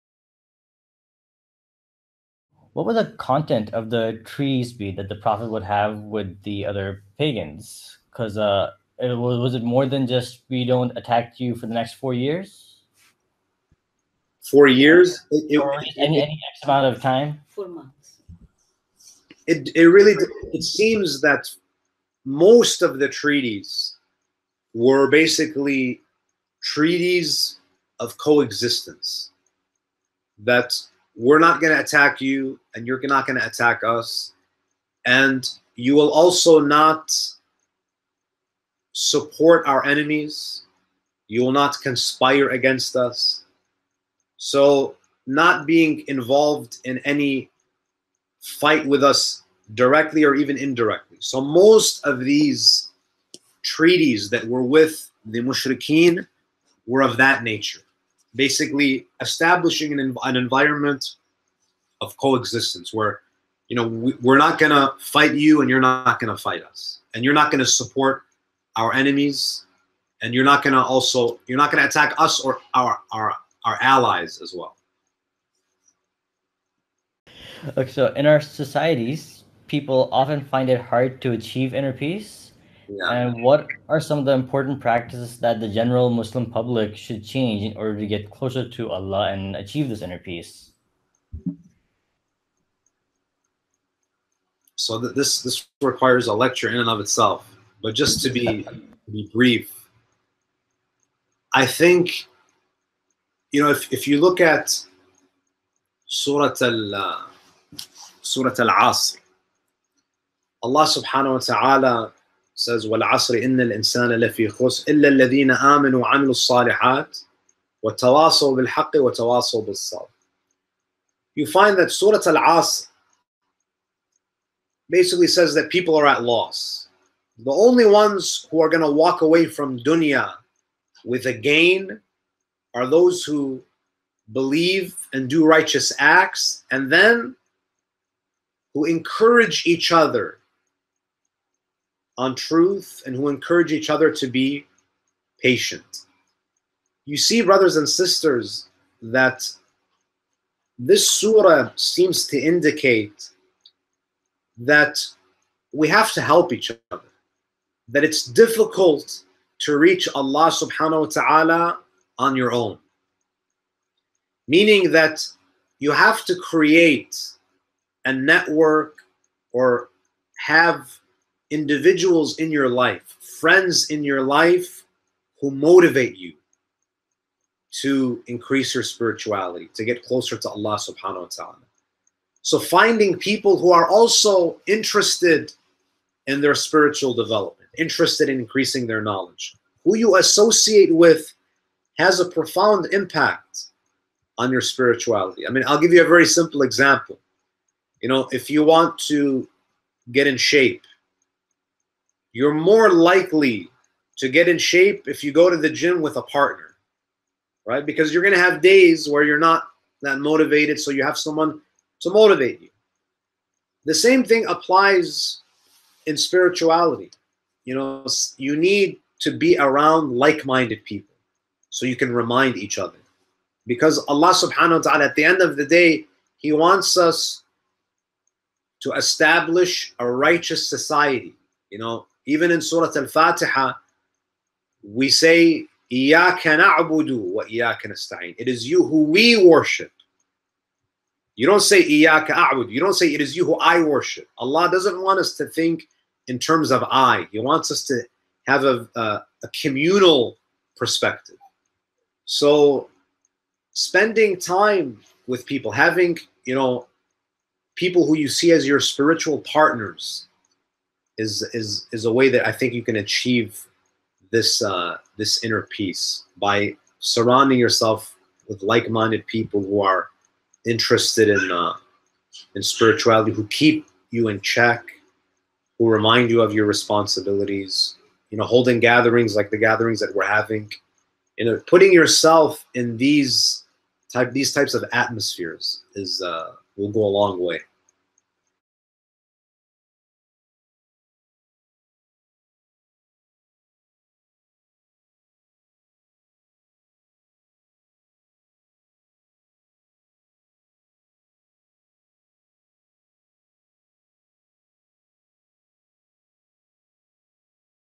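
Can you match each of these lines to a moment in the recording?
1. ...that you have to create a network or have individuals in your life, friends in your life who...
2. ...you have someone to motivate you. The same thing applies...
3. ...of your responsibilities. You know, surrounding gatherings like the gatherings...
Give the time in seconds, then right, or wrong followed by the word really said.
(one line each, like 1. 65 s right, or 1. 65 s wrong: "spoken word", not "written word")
1. 164 s right
2. 210 s right
3. 276 s wrong: "holding", not "surrounding".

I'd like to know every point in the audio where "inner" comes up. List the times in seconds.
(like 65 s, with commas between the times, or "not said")
81 s, 90 s, 265 s.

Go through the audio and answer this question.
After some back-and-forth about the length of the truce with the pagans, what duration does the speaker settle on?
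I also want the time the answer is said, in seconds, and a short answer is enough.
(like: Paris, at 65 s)
4 months, at 17 s.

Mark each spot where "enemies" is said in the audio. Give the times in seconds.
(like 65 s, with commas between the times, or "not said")
39 s, 68 s.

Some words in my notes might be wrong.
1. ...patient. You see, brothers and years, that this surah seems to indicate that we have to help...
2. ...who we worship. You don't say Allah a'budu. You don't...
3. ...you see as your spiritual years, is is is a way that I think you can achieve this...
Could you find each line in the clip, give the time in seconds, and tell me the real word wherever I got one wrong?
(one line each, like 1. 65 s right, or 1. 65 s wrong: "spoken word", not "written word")
1. 145 s wrong: "sisters", not "years"
2. 238 s wrong: "Iyaka", not "Allah"
3. 258 s wrong: "partners", not "years".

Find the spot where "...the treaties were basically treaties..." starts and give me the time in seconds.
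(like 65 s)
22 s.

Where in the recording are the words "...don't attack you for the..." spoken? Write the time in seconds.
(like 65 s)
10 s.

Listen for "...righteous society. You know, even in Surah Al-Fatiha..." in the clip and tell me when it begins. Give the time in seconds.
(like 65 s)
230 s.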